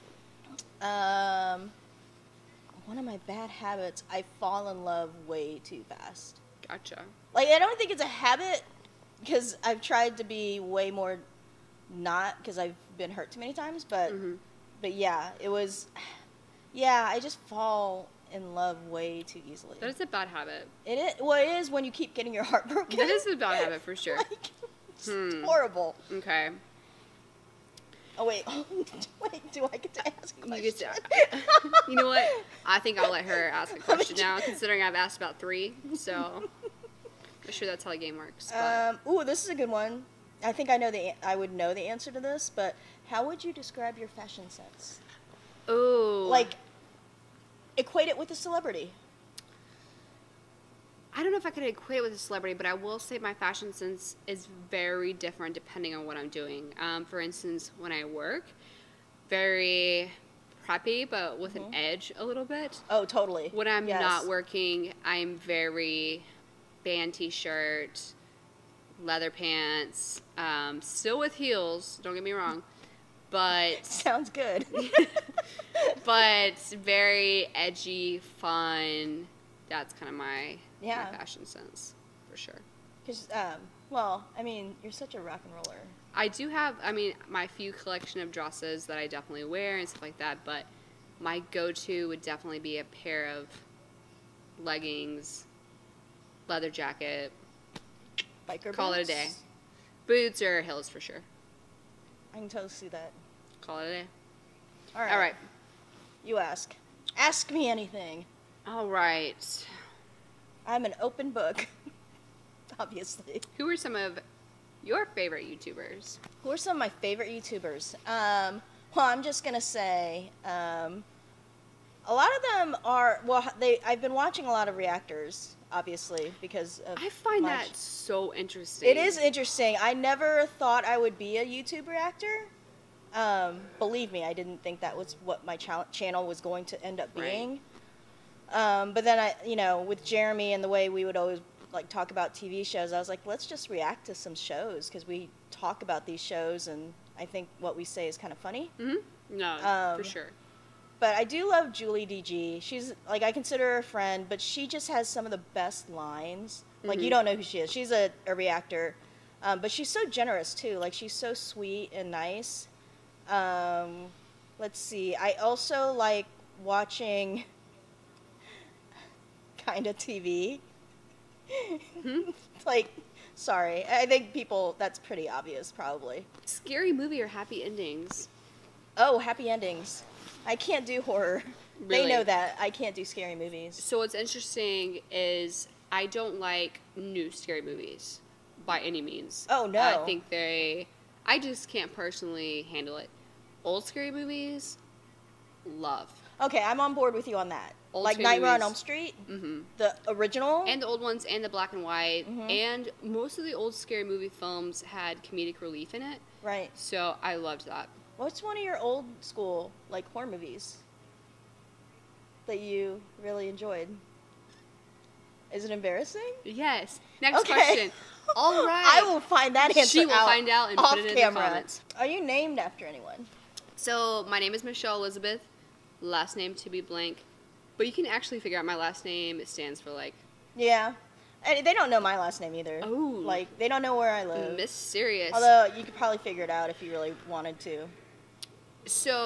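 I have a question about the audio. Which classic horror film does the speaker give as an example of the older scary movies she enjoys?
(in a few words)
Nightmare on Elm Street.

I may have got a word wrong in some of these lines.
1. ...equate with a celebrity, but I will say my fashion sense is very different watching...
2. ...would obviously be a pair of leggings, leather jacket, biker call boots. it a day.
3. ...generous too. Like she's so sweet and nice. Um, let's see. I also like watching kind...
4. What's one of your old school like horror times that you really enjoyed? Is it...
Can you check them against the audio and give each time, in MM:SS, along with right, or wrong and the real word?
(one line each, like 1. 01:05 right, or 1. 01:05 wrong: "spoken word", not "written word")
1. 00:51 wrong: "depending", not "watching"
2. 01:32 wrong: "definitely", not "obviously"
3. 02:40 right
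4. 03:28 wrong: "movies", not "times".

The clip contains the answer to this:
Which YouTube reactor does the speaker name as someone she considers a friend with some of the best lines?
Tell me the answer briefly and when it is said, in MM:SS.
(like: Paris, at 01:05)
Julie DG, at 02:31.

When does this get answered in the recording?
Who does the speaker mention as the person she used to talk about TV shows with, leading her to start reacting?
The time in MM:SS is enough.
02:20.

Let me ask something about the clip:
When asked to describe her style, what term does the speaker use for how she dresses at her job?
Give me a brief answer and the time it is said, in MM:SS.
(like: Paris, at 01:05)
preppy, at 00:59.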